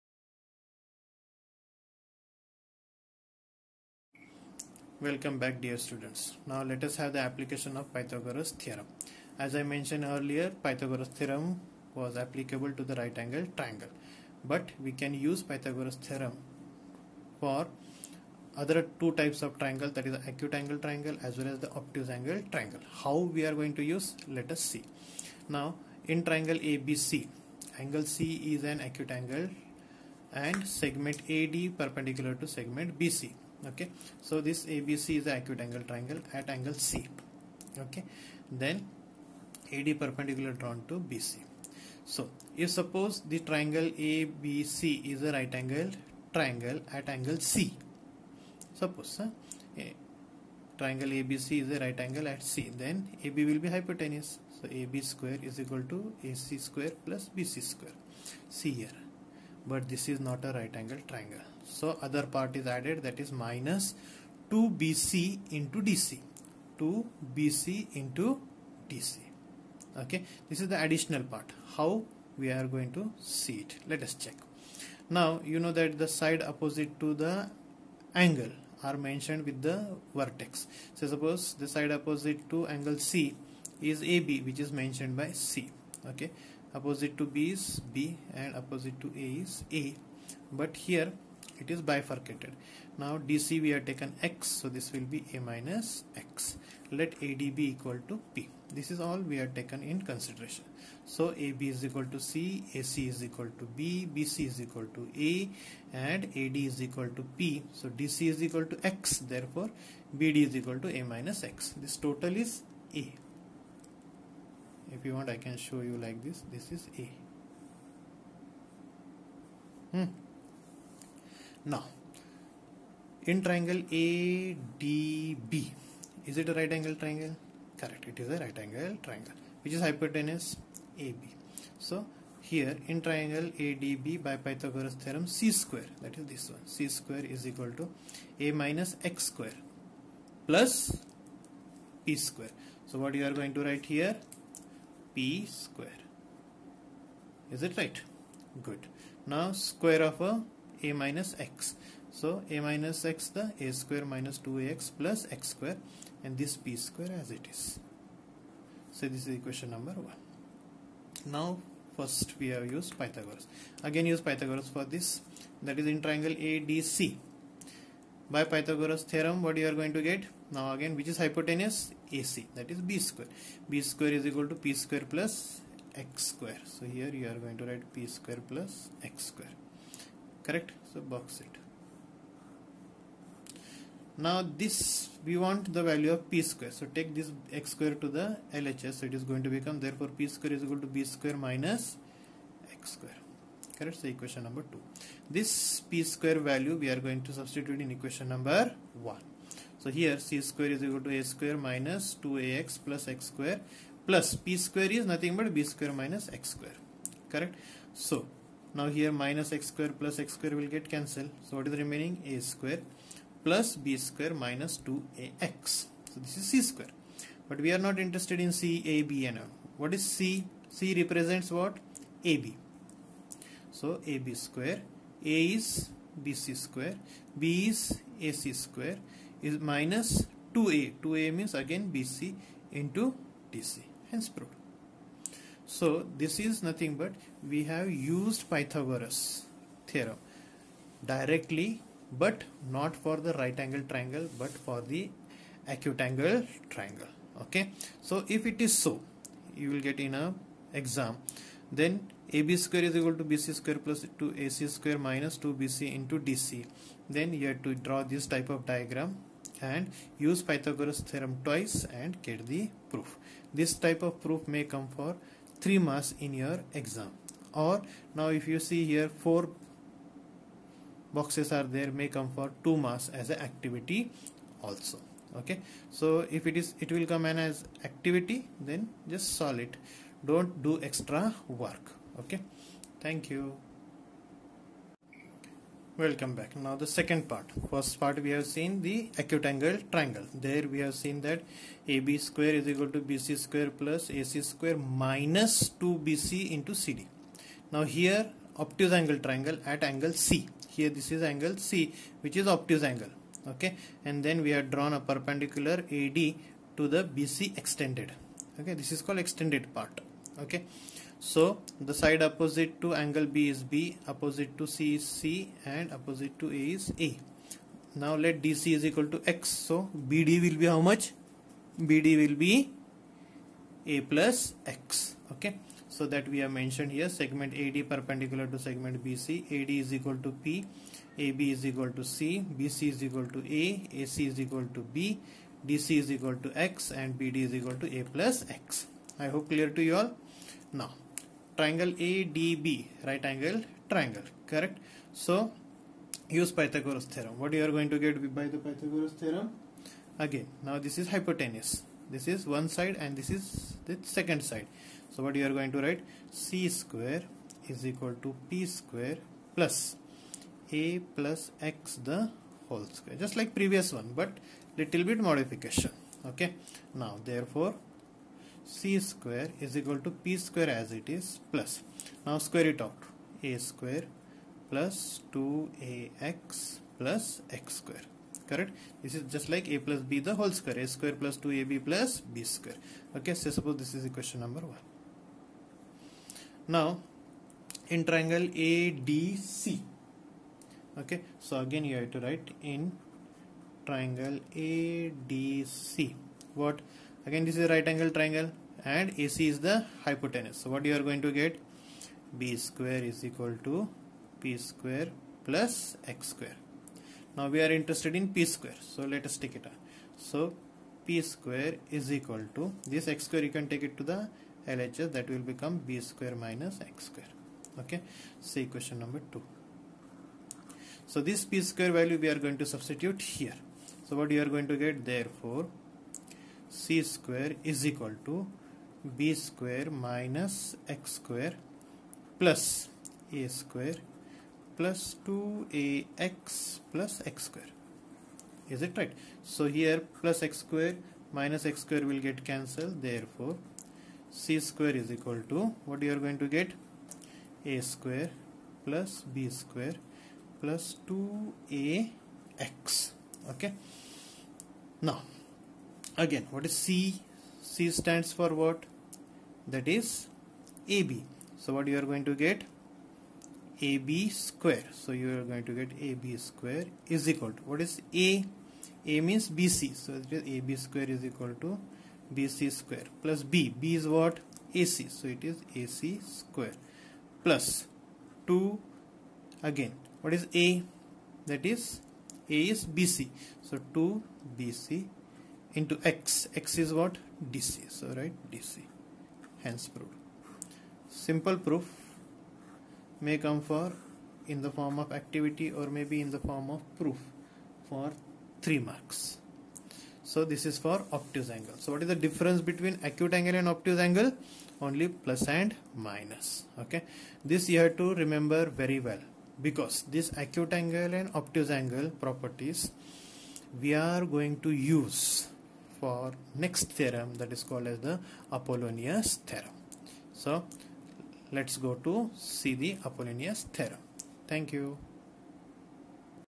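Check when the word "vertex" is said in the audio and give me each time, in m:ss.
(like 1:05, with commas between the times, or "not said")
1:20.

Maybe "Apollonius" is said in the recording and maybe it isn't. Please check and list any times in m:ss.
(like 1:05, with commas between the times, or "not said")
8:38, 8:43.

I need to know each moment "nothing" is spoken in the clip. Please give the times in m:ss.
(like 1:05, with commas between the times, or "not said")
3:25, 3:56.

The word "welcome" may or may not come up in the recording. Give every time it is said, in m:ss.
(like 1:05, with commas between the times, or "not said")
0:05, 4:45.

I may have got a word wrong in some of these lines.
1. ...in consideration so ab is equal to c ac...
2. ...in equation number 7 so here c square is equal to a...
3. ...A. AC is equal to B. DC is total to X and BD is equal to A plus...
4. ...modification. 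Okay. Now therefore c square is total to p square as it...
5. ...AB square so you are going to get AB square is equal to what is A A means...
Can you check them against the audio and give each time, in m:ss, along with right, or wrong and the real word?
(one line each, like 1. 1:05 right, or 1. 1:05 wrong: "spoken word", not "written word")
1. 1:39 right
2. 3:17 wrong: "1", not "7"
3. 5:33 wrong: "equal", not "total"
4. 6:05 wrong: "equal", not "total"
5. 7:43 right.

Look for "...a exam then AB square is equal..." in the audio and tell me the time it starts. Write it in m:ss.
4:10.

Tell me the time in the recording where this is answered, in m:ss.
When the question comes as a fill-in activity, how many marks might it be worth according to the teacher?
4:32.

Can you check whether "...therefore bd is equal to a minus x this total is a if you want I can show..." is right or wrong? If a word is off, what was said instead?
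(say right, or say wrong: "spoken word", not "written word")
right.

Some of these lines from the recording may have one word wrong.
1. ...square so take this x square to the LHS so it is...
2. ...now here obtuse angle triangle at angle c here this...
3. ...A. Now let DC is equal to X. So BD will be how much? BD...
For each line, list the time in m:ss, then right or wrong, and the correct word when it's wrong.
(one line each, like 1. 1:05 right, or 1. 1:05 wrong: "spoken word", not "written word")
1. 3:06 right
2. 4:57 right
3. 5:16 right.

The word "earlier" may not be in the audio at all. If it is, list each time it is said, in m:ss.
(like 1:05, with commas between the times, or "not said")
0:10.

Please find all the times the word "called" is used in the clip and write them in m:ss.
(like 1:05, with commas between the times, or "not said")
5:09, 8:37.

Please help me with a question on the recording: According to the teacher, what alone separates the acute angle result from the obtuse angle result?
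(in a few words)
plus and minus.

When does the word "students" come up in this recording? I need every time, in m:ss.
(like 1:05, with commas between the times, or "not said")
0:05.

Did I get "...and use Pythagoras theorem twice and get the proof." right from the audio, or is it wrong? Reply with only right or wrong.
right.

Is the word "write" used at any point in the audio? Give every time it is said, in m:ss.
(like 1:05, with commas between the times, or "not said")
2:23, 2:57, 5:55, 6:32.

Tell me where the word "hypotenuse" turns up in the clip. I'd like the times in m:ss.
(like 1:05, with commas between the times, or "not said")
0:53, 2:09, 2:51, 5:51, 6:40.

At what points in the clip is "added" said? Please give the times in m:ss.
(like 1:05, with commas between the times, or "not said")
1:02.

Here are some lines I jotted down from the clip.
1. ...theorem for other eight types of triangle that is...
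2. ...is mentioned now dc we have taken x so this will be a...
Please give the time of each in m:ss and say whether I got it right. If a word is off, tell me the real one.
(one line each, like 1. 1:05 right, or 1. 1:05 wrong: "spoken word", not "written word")
1. 0:15 wrong: "two", not "eight"
2. 1:31 wrong: "bifurcated", not "mentioned".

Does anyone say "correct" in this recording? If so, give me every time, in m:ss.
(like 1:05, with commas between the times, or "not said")
2:07, 3:00, 3:13, 3:27, 5:44, 6:18.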